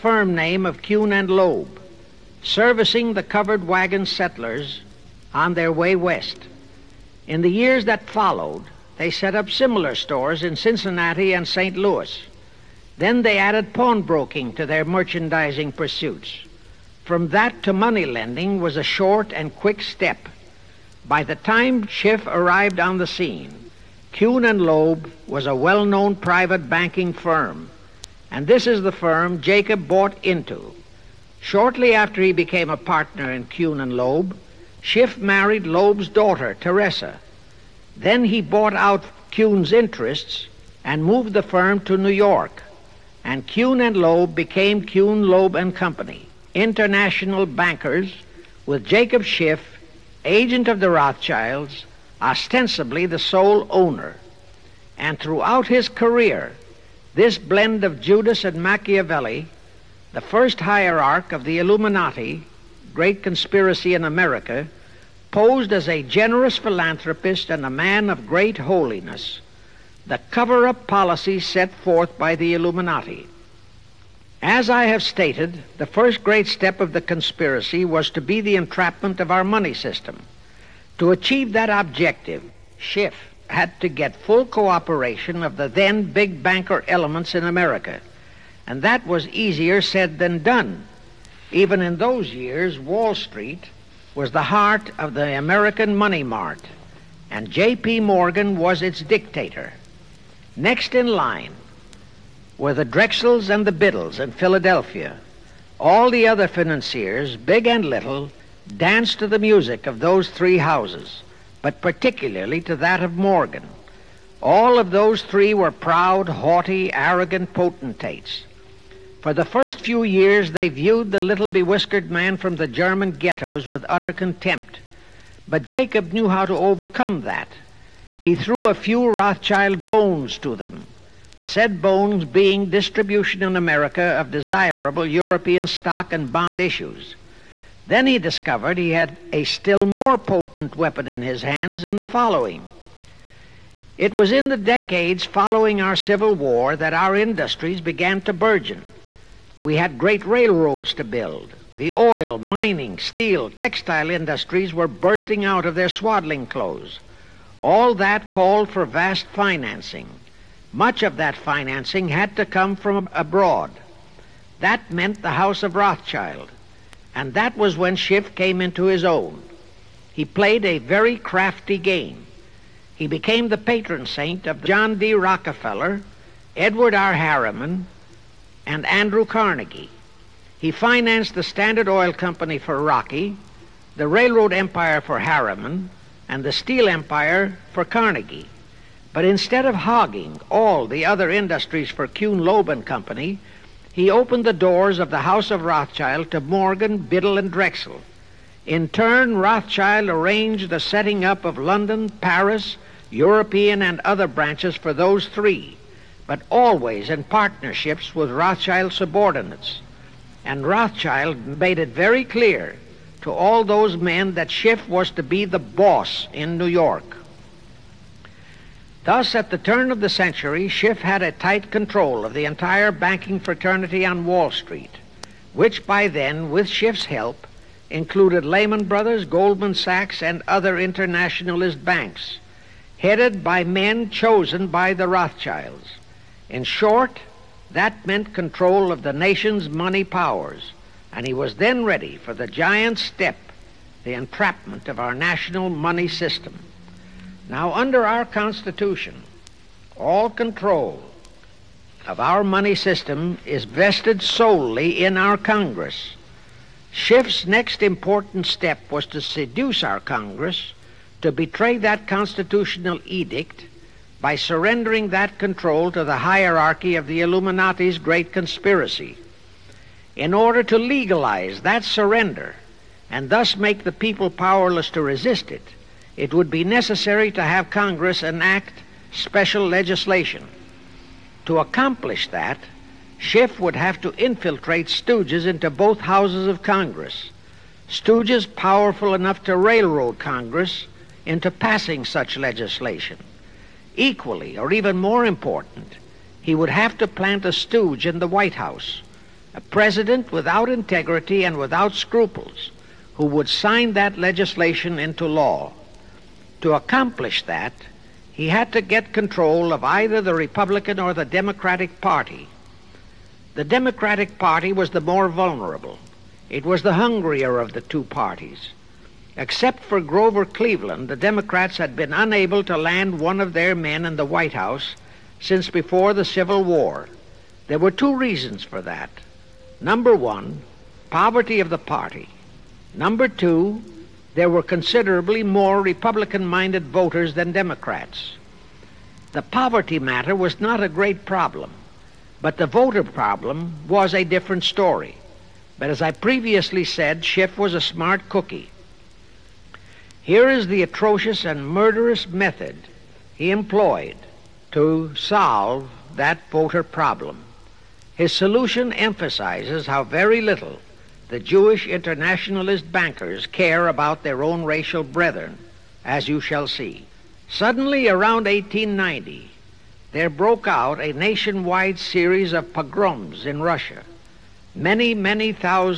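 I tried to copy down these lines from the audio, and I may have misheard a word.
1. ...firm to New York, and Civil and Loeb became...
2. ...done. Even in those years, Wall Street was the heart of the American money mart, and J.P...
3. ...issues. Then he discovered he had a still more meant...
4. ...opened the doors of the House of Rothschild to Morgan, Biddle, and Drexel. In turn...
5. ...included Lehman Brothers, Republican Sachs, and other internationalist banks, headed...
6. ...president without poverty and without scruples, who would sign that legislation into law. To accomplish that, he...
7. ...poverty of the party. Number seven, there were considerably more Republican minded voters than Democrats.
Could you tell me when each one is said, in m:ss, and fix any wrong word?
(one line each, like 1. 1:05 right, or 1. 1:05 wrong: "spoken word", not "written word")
1. 0:41 wrong: "Kuhn", not "Civil"
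2. 1:30 right
3. 2:16 wrong: "potent", not "meant"
4. 3:14 right
5. 3:47 wrong: "Goldman", not "Republican"
6. 4:59 wrong: "integrity", not "poverty"
7. 5:31 wrong: "two", not "seven".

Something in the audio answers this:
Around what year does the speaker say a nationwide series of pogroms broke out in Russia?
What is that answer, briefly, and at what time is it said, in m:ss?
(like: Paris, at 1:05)
1890, at 6:08.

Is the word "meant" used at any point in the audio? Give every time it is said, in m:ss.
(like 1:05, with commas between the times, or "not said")
2:44, 3:58.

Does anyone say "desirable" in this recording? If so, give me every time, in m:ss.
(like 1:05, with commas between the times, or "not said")
2:14.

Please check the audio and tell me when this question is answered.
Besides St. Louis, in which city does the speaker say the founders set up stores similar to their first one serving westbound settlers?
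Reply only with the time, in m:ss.
0:10.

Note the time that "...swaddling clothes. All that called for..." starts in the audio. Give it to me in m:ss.
2:35.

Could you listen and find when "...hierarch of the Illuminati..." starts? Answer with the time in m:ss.
1:00.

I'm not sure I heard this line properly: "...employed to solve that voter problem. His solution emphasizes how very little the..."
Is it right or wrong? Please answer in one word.
right.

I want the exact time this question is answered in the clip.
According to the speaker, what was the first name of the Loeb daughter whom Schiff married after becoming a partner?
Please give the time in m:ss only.
0:36.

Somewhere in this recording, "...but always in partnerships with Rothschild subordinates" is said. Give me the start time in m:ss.
3:26.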